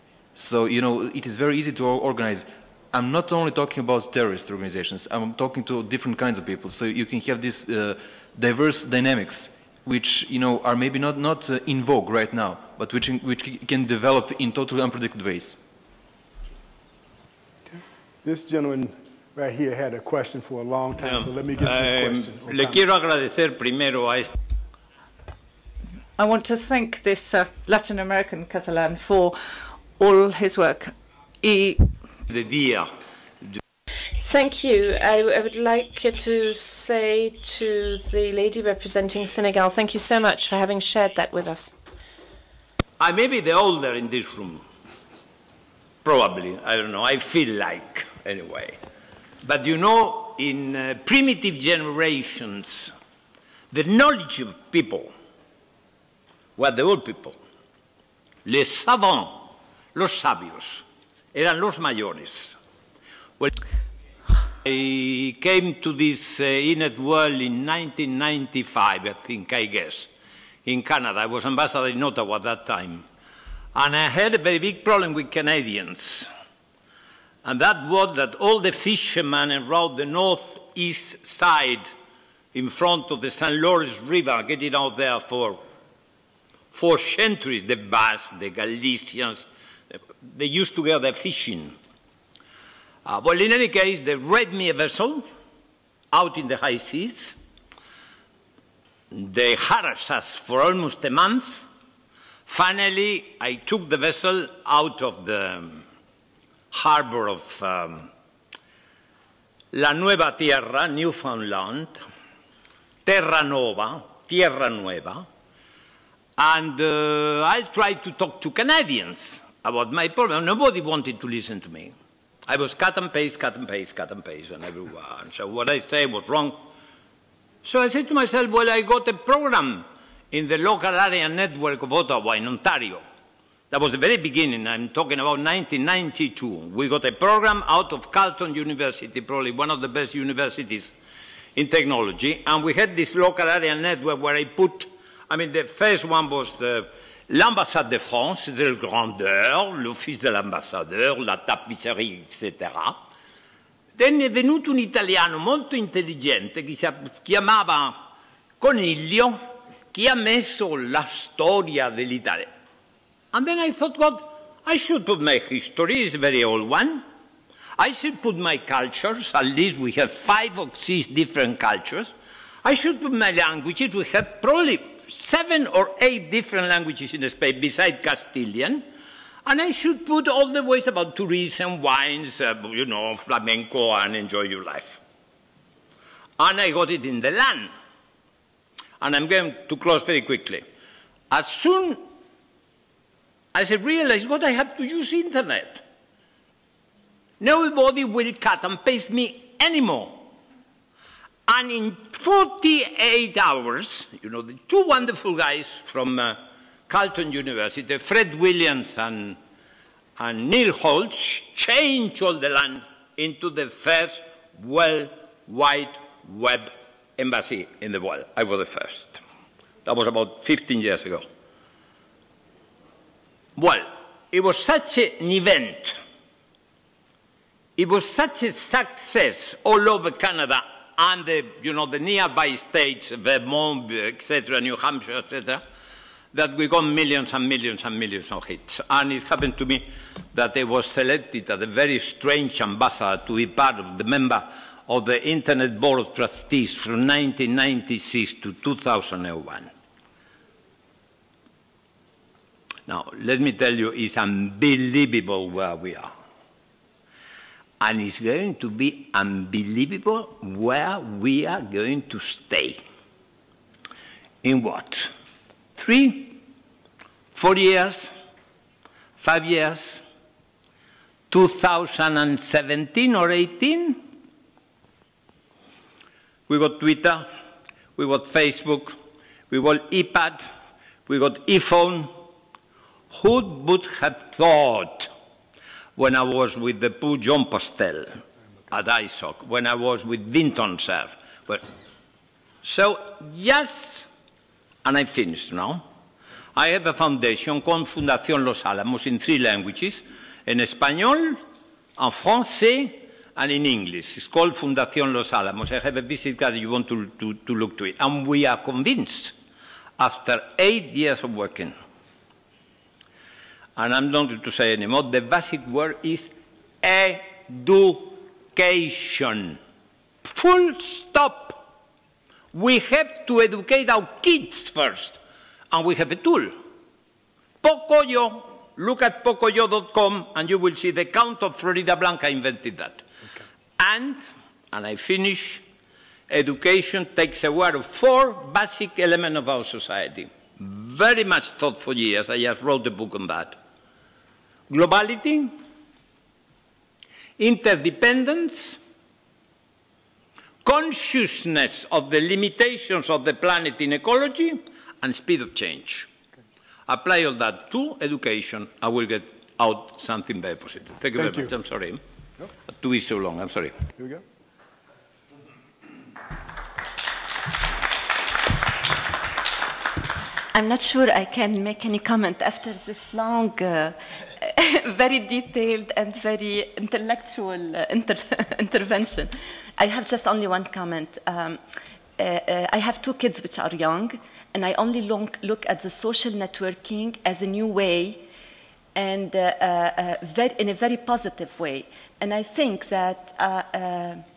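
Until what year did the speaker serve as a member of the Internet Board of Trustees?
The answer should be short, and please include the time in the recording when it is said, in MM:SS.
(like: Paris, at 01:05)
2001, at 04:06.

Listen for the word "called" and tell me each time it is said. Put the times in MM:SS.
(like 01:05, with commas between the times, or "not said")
04:57, 05:04.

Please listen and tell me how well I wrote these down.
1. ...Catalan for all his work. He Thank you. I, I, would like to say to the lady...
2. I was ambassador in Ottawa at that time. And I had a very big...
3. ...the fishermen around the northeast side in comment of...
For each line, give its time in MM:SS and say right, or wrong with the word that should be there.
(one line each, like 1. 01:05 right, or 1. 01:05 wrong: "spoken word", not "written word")
1. 00:28 right
2. 01:11 right
3. 01:18 wrong: "front", not "comment".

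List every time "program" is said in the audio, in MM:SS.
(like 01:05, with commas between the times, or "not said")
02:09, 02:17.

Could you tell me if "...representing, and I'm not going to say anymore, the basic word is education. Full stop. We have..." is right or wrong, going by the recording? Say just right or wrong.
wrong.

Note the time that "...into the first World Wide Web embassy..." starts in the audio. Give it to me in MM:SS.
03:33.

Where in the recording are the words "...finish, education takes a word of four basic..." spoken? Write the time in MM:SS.
05:34.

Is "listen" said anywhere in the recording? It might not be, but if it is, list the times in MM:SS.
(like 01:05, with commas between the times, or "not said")
02:01.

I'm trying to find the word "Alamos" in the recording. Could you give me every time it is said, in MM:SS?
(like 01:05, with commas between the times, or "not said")
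04:58, 05:05.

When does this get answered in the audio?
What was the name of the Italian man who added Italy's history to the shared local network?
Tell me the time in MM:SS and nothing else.
02:38.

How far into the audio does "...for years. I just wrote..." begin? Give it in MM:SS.
05:41.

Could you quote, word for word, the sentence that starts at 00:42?
I may be the older in this room.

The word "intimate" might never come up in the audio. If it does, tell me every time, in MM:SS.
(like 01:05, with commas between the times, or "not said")
not said.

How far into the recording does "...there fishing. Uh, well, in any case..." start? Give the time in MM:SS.
01:30.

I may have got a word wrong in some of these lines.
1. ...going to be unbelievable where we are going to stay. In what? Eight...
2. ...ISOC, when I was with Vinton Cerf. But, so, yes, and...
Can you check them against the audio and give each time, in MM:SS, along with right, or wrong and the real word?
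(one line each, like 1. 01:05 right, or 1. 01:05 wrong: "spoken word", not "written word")
1. 04:18 wrong: "Three", not "Eight"
2. 04:48 right.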